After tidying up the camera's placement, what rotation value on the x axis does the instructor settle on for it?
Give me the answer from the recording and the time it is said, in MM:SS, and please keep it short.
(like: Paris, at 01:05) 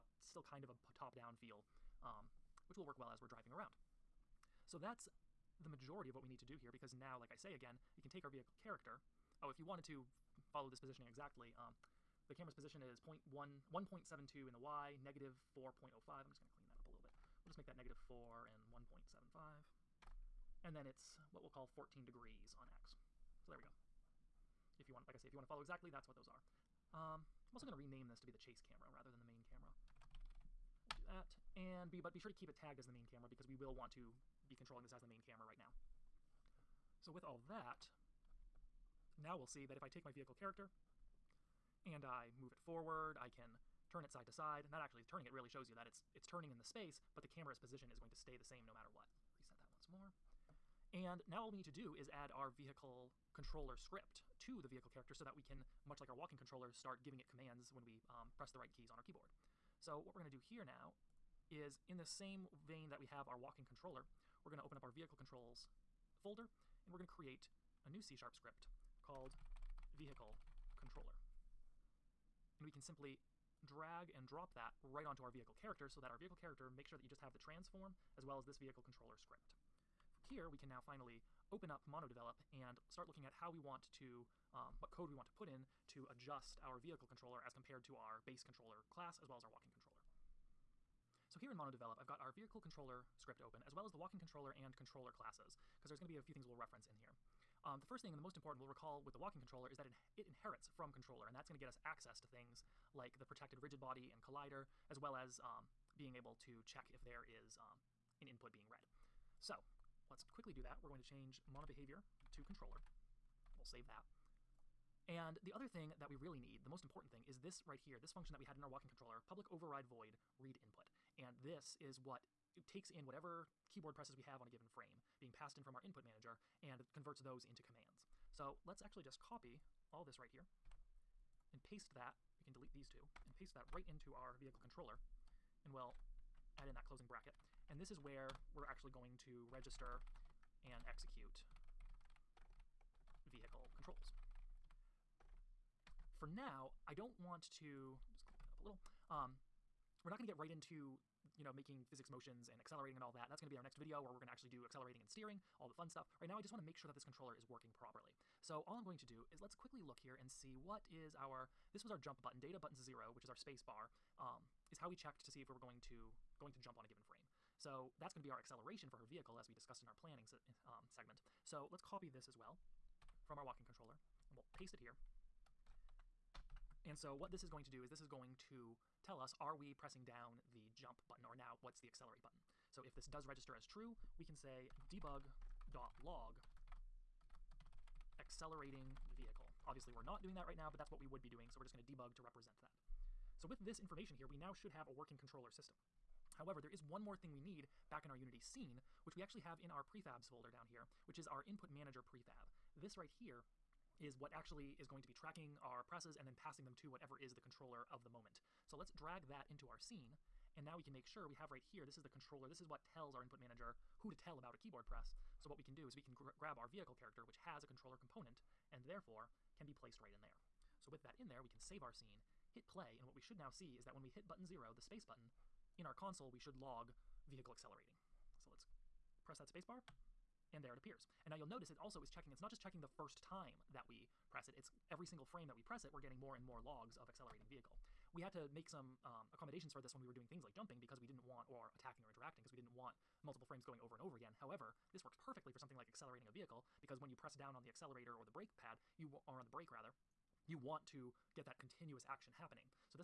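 14 degrees, at 00:21.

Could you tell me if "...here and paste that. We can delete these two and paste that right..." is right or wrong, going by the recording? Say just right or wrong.
right.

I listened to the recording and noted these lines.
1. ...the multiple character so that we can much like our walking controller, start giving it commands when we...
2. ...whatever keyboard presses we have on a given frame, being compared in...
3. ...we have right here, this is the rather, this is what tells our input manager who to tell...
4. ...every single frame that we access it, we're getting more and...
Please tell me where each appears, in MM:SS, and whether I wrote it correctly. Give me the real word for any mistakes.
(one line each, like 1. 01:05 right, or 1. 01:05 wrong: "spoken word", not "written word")
1. 00:54 wrong: "vehicle", not "multiple"
2. 02:03 wrong: "passed", not "compared"
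3. 03:31 wrong: "controller", not "rather"
4. 03:54 wrong: "press", not "access".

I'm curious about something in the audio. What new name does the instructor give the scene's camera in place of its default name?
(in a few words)
chase camera.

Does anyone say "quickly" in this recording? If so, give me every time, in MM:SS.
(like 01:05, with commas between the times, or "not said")
01:50, 02:39.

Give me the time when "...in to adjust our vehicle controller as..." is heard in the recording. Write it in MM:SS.
01:25.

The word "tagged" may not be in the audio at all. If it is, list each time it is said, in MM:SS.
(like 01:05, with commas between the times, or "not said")
00:32.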